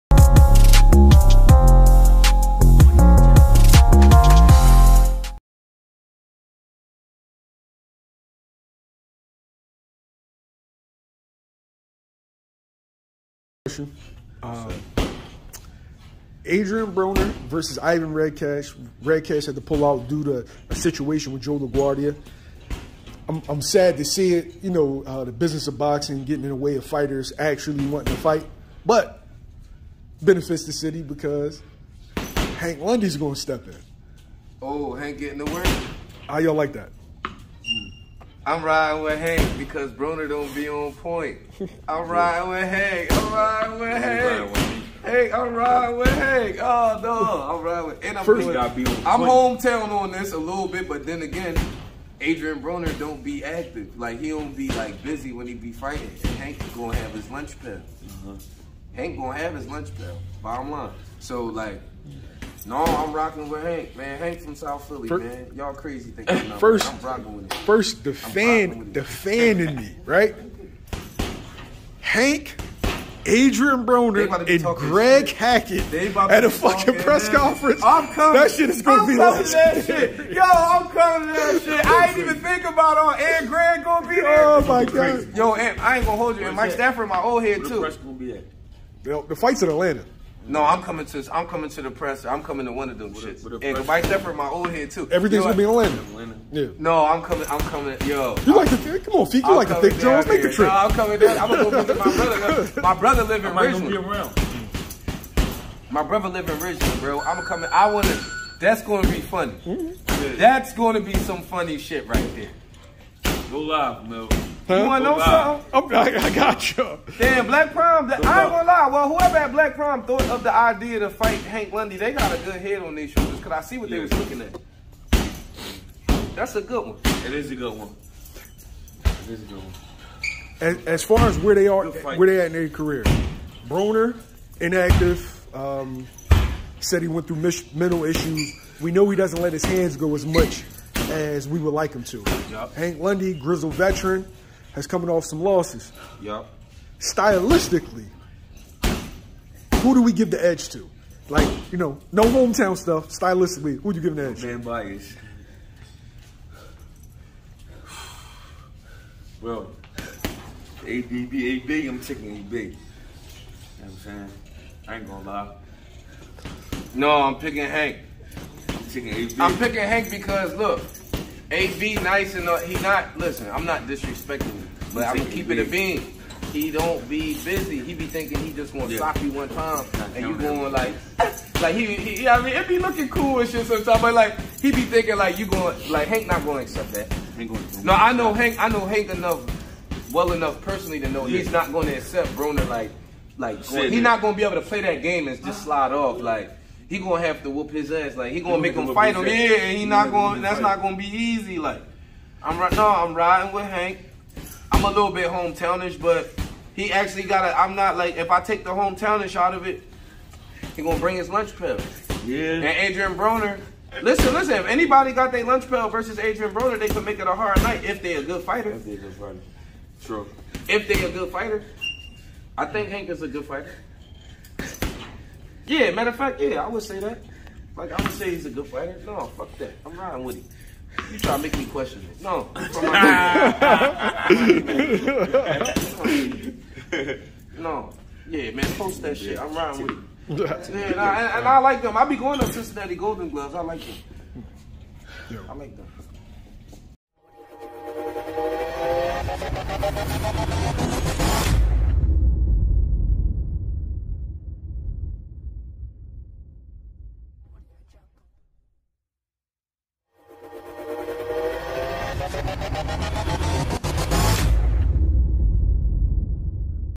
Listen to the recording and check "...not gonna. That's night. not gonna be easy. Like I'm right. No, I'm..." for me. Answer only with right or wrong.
wrong.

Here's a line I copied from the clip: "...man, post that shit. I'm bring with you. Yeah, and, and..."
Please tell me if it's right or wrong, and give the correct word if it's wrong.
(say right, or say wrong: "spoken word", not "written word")
wrong: "riding", not "bring".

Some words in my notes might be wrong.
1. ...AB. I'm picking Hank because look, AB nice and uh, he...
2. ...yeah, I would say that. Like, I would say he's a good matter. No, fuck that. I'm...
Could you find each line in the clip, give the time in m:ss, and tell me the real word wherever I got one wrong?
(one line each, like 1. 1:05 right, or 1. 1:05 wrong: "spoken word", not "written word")
1. 2:49 right
2. 3:46 wrong: "fighter", not "matter".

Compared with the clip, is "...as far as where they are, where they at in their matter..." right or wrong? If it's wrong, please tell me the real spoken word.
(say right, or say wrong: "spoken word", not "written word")
wrong: "career", not "matter".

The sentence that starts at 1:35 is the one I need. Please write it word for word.
Everything's you know, gonna be in Atlanta.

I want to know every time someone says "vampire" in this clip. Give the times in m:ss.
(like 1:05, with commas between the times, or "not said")
not said.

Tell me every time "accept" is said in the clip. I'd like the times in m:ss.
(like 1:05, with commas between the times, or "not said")
3:06, 3:11.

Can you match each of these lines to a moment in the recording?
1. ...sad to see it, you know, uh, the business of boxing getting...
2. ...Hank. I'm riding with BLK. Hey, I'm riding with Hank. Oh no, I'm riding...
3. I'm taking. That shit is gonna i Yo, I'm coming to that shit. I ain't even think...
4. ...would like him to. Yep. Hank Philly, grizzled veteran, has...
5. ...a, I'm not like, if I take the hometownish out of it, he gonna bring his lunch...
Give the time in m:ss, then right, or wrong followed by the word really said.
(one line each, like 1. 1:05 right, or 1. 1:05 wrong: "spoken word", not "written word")
1. 0:23 right
2. 0:42 wrong: "Hank", not "BLK"
3. 1:17 wrong: "coming", not "taking"
4. 2:21 wrong: "Lundy", not "Philly"
5. 3:27 right.